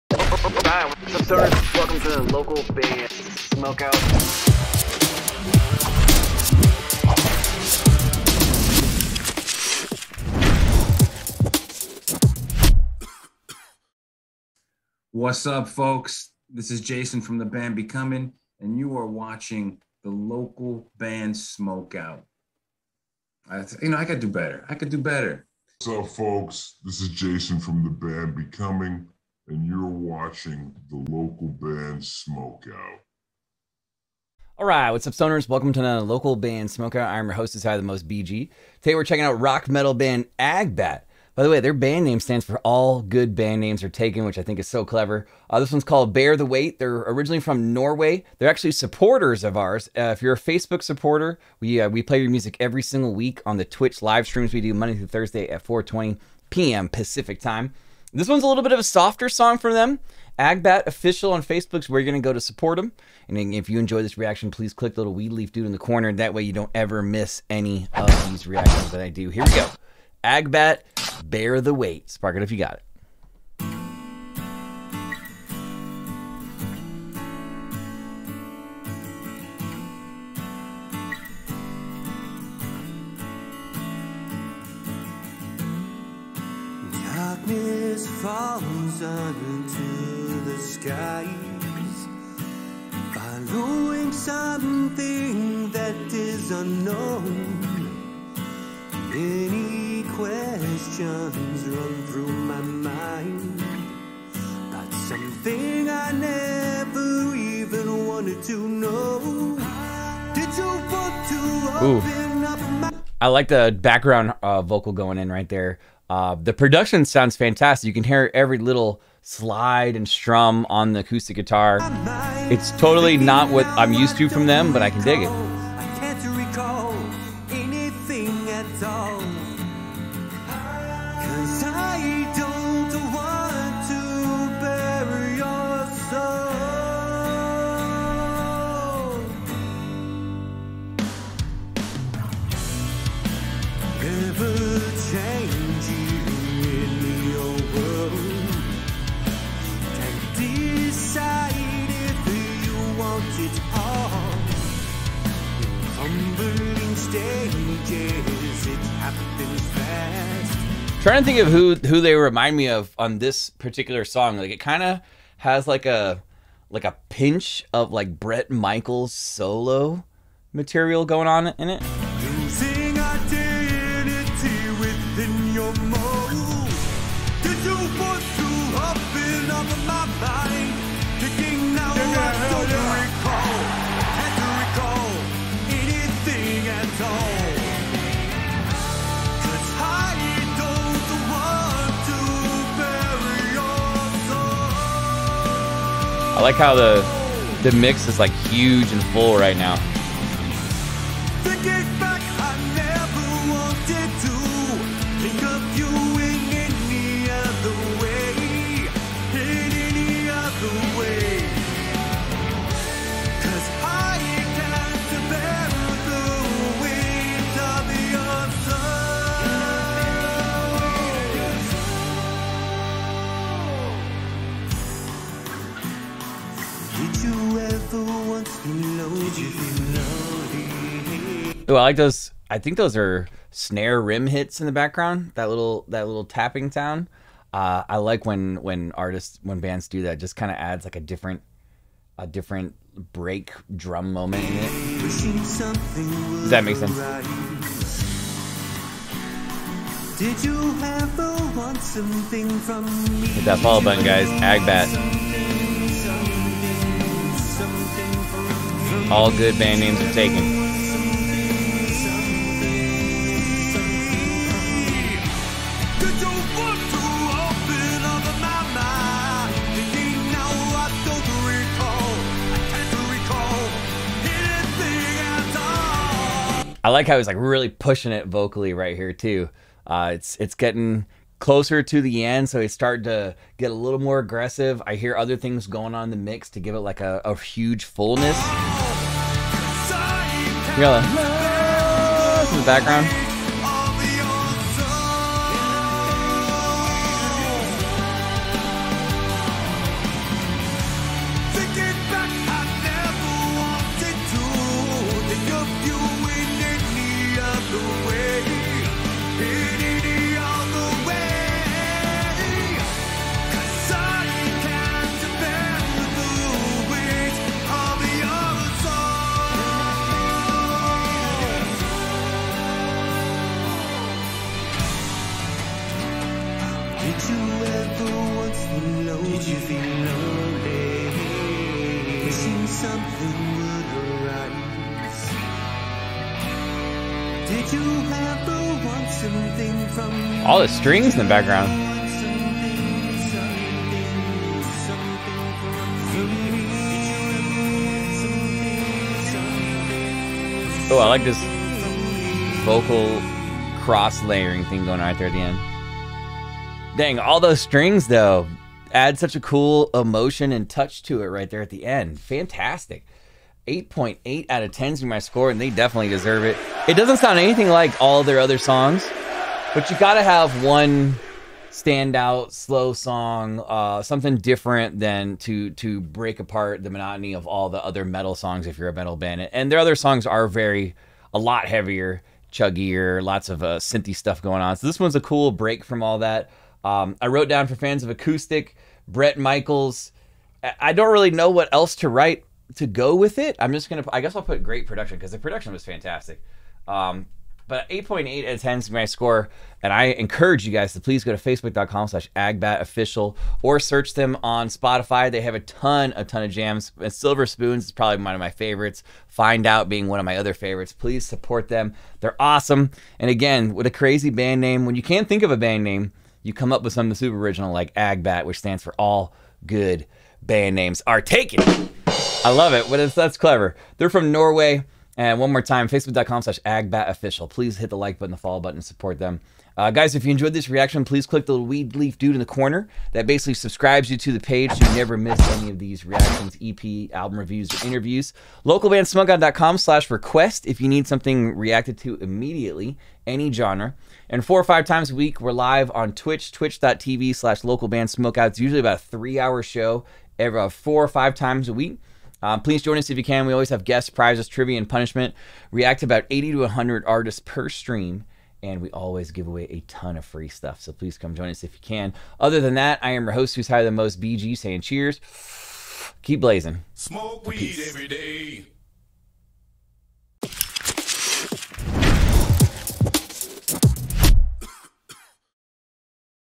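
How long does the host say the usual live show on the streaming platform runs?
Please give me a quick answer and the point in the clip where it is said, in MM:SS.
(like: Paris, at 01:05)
3 hours, at 07:29.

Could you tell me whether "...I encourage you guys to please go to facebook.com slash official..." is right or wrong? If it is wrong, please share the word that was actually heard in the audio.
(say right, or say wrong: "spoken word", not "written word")
wrong: "agbatofficial", not "official".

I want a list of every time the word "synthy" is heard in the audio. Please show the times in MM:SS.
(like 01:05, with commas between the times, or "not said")
06:23.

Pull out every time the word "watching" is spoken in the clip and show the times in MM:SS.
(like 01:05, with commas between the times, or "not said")
00:19, 00:30.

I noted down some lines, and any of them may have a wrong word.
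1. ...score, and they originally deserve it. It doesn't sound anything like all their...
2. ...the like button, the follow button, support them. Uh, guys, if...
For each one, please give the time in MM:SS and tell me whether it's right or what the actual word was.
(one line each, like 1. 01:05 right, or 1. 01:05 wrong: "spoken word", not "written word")
1. 06:05 wrong: "definitely", not "originally"
2. 07:07 right.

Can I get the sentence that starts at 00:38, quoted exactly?
Today we're checking out rock metal band Agbat.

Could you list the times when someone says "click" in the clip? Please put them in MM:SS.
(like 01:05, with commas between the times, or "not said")
01:04, 07:11.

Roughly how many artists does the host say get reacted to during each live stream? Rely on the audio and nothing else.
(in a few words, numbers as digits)
80 to 100.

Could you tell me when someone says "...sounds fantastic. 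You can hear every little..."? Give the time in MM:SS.
01:57.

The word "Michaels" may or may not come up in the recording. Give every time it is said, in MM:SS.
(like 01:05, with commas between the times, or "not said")
02:48, 06:29.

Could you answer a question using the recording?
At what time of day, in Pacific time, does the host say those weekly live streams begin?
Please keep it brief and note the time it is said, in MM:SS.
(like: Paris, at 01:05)
4:20 p.m., at 00:55.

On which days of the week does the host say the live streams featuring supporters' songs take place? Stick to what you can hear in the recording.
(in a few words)
Monday through Thursday.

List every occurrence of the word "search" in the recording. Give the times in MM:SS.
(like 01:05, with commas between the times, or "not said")
06:43.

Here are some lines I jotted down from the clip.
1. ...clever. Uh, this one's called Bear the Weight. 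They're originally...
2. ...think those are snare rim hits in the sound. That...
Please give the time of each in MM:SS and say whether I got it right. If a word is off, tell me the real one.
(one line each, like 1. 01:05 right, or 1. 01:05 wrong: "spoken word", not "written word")
1. 00:44 right
2. 03:52 wrong: "background", not "sound".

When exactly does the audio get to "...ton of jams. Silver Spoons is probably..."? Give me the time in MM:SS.
06:46.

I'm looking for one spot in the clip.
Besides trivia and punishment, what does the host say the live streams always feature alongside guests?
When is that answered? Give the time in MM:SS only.
07:34.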